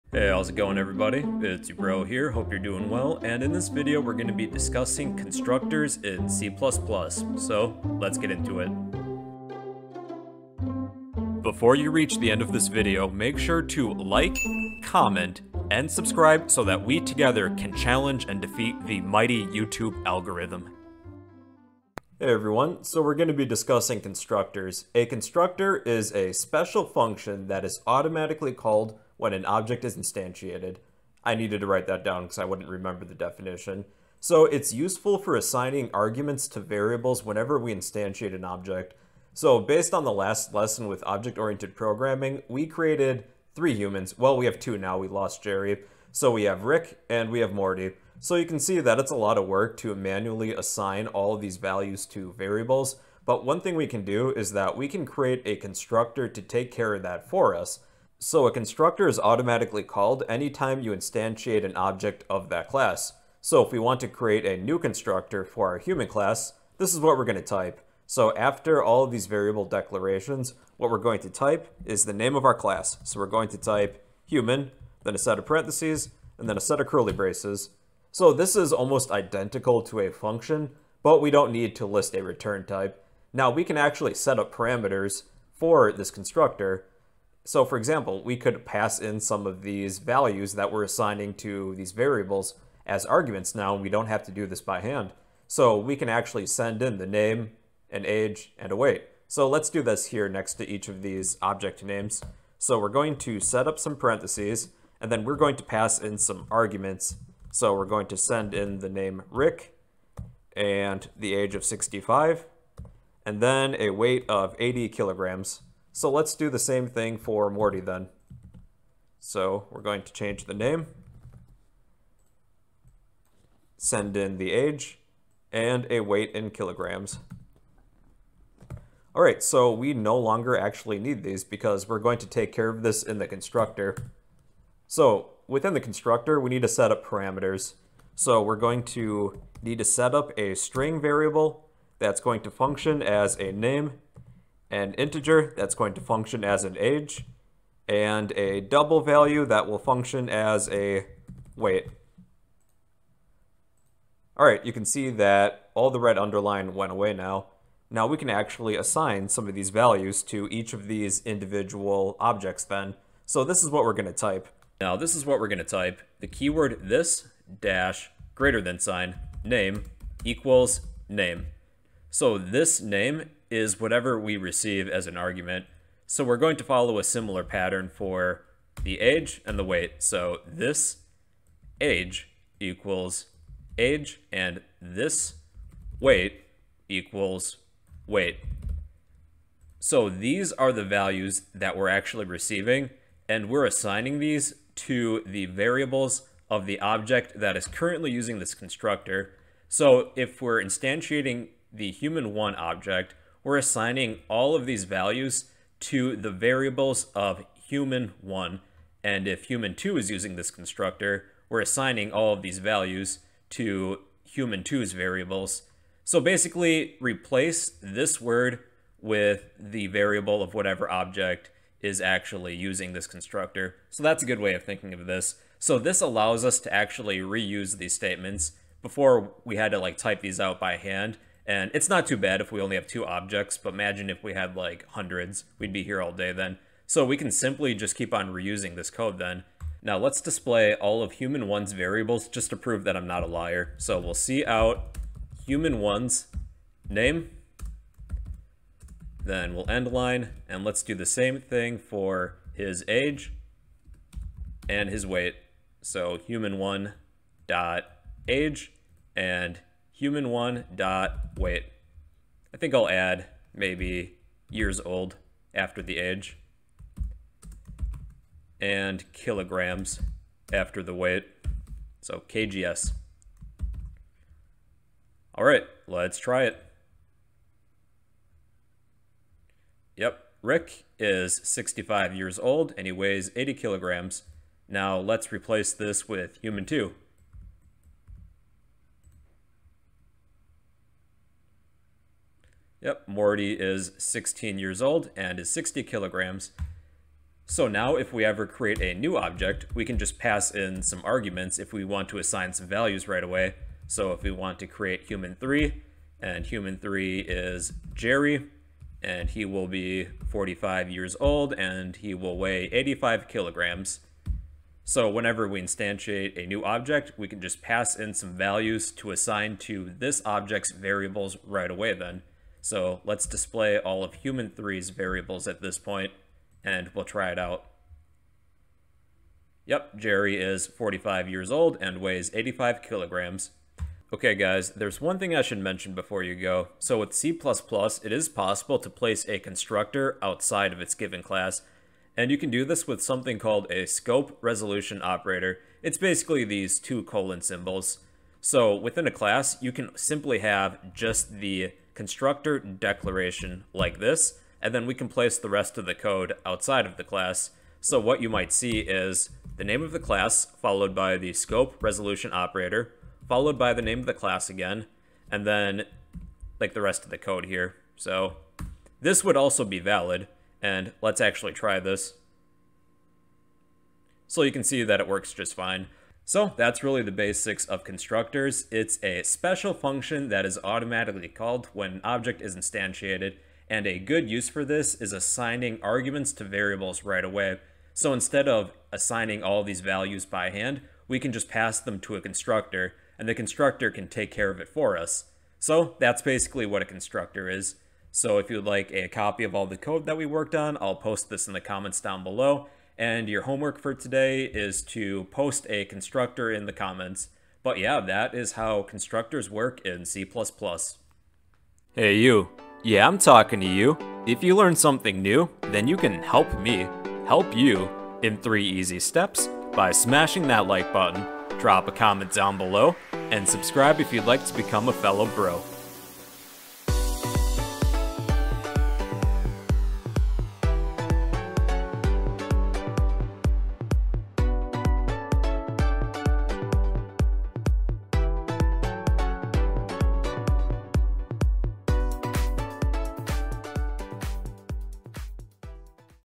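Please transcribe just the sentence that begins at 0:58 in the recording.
So a constructor is automatically called anytime you instantiate an object of that class.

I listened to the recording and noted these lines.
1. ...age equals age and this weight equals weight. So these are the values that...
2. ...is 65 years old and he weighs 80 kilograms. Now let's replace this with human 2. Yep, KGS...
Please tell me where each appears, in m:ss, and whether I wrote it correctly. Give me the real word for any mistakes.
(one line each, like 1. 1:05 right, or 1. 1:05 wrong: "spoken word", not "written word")
1. 3:01 right
2. 4:40 wrong: "Morty", not "KGS".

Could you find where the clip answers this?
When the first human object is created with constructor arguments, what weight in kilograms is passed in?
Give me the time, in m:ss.
1:53.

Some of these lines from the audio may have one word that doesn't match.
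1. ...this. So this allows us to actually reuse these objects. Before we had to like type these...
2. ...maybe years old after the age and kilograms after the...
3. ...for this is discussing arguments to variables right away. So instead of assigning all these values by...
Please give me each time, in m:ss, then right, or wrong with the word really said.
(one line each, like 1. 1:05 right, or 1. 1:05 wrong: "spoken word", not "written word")
1. 3:45 wrong: "statements", not "objects"
2. 4:23 right
3. 6:24 wrong: "assigning", not "discussing".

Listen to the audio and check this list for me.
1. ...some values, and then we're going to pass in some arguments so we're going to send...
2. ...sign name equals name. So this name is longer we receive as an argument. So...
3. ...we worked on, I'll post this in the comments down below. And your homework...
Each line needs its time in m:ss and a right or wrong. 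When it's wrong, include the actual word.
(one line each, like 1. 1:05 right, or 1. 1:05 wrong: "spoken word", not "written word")
1. 1:43 wrong: "parentheses", not "values"
2. 2:48 wrong: "whatever", not "longer"
3. 6:40 right.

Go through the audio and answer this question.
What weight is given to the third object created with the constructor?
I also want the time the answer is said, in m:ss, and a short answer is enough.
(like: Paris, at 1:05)
85 kilograms, at 5:12.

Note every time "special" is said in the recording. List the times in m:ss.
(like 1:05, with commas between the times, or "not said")
0:26, 6:19.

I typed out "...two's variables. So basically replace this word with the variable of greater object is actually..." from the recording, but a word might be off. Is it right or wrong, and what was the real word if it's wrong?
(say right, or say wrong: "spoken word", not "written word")
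wrong: "whatever", not "greater".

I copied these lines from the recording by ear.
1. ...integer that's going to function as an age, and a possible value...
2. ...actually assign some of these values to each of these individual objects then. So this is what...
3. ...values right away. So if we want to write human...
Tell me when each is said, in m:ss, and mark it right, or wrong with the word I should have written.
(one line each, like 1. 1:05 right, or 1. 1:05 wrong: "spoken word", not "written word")
1. 2:24 wrong: "double", not "possible"
2. 2:38 right
3. 5:02 wrong: "create", not "write".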